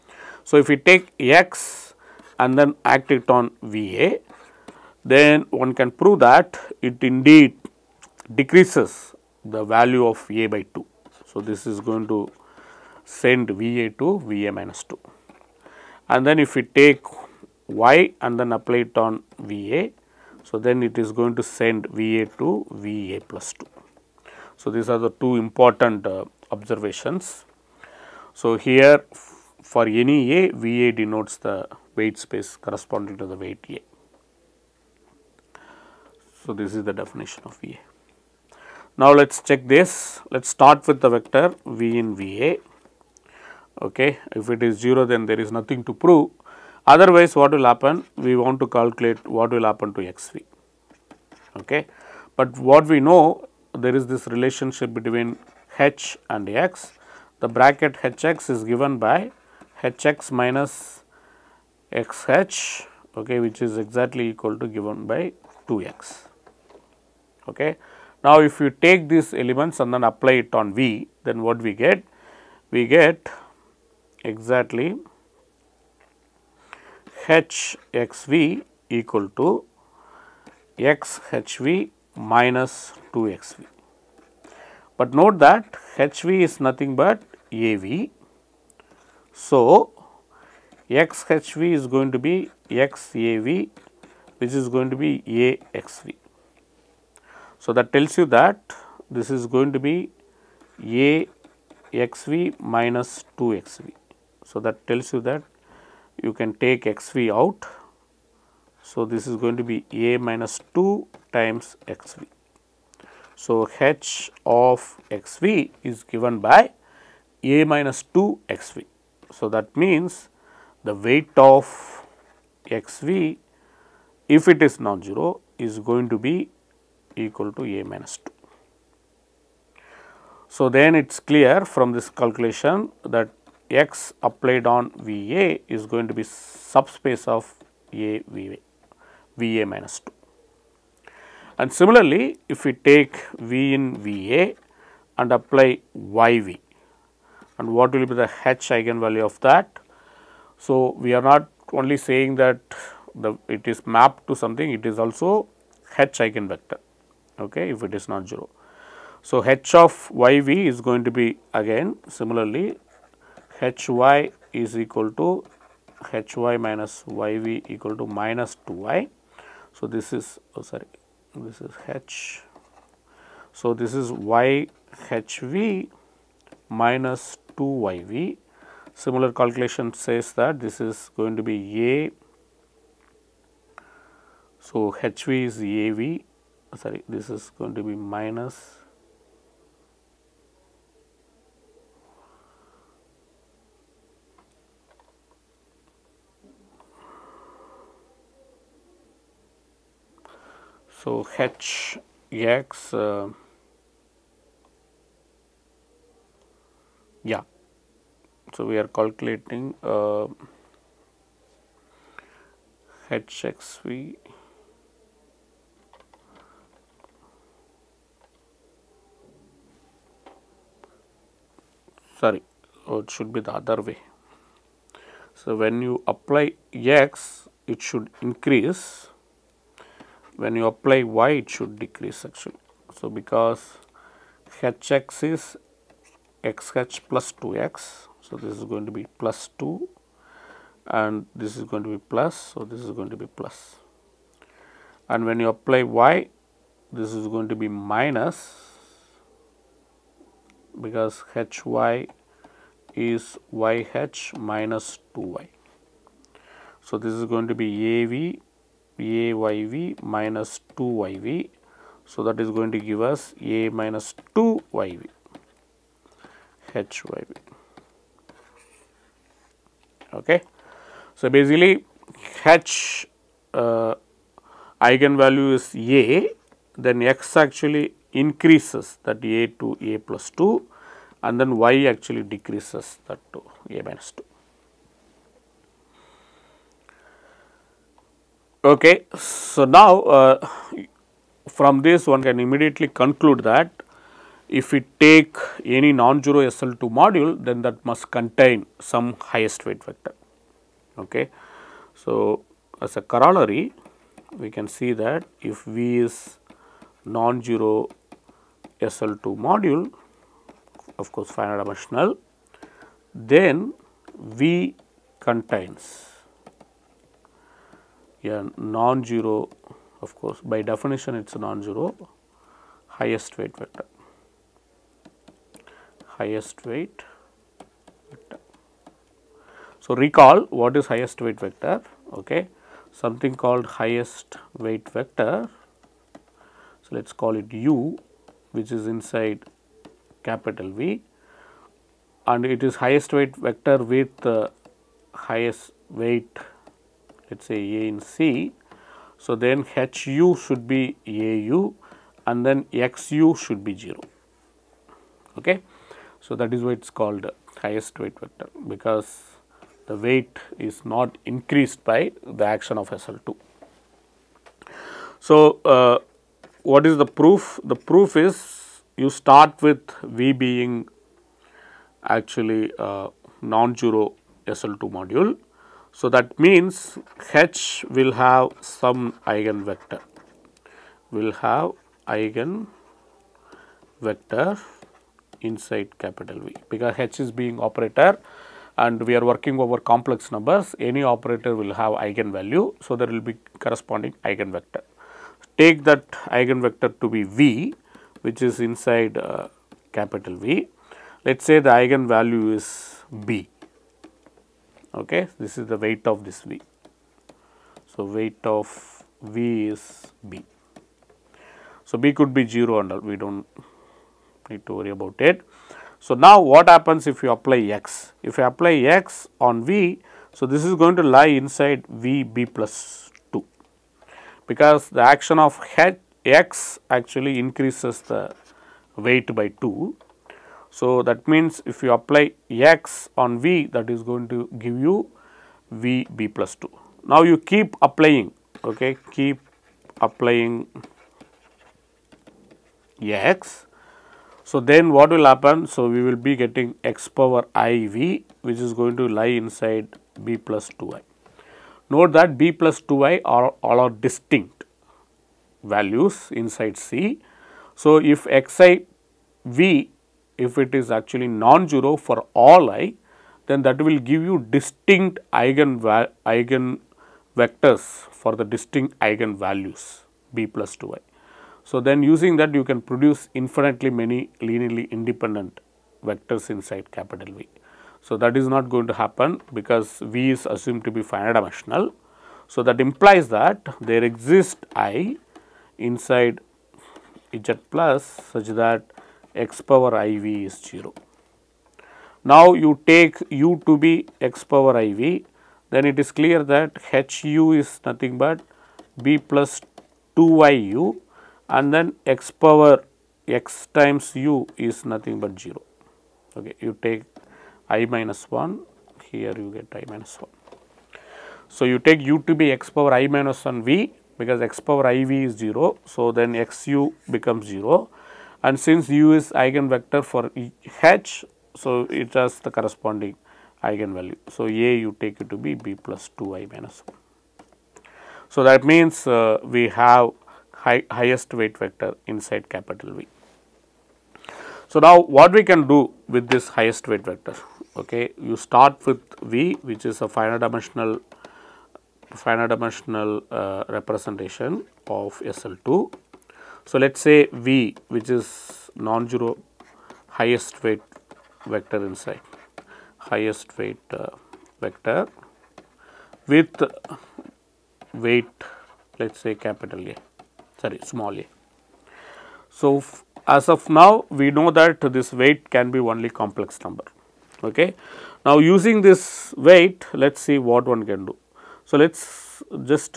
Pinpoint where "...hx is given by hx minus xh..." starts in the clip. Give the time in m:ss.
0:58.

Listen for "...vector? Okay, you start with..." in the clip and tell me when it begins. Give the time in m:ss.
8:57.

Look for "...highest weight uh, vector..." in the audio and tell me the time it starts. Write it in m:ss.
9:13.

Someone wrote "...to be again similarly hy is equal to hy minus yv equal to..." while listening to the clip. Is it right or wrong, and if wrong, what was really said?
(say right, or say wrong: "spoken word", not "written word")
right.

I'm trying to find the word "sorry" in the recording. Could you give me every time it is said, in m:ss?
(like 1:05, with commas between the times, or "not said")
2:50, 3:06, 3:42, 9:20.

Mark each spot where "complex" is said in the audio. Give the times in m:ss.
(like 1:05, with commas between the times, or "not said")
6:29, 9:26.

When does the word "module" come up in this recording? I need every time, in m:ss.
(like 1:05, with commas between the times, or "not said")
4:56, 5:09, 6:14.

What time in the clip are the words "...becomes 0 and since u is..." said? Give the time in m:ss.
8:37.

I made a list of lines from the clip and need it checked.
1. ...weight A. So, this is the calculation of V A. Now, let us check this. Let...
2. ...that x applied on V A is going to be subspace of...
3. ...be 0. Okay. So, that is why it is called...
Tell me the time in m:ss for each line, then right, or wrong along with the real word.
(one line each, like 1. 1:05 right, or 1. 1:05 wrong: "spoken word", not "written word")
1. 0:33 wrong: "definition", not "calculation"
2. 2:13 right
3. 5:53 right.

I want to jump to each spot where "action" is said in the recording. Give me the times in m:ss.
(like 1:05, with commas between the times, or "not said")
6:02, 7:05.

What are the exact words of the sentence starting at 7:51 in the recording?
So, then using that you can produce infinitely many linearly independent vectors inside capital V.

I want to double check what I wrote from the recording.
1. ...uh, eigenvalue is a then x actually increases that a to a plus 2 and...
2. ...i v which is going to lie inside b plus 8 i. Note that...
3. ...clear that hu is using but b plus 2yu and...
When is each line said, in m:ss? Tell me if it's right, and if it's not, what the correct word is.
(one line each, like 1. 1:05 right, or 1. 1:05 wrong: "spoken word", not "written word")
1. 4:33 right
2. 7:27 wrong: "2", not "8"
3. 8:16 wrong: "nothing", not "using".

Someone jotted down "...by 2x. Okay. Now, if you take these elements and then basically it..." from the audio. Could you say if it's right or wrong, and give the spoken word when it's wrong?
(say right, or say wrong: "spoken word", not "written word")
wrong: "apply", not "basically".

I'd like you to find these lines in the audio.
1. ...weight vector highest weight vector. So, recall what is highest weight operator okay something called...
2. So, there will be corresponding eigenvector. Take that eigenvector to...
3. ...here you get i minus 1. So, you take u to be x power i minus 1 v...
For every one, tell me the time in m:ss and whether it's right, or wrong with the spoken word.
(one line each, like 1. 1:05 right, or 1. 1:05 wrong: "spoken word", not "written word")
1. 5:23 wrong: "vector", not "operator"
2. 6:32 right
3. 8:29 right.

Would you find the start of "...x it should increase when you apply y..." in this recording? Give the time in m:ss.
3:46.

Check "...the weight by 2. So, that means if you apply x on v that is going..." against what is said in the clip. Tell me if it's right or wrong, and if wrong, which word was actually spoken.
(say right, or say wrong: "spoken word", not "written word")
right.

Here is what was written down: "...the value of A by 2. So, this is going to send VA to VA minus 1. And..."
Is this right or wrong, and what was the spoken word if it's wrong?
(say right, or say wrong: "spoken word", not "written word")
wrong: "2", not "1".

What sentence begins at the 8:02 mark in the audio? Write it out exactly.
So, that implies that there exists i inside z plus such that x power iv is 0.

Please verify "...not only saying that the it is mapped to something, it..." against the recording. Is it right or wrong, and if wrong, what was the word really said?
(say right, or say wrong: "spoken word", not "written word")
right.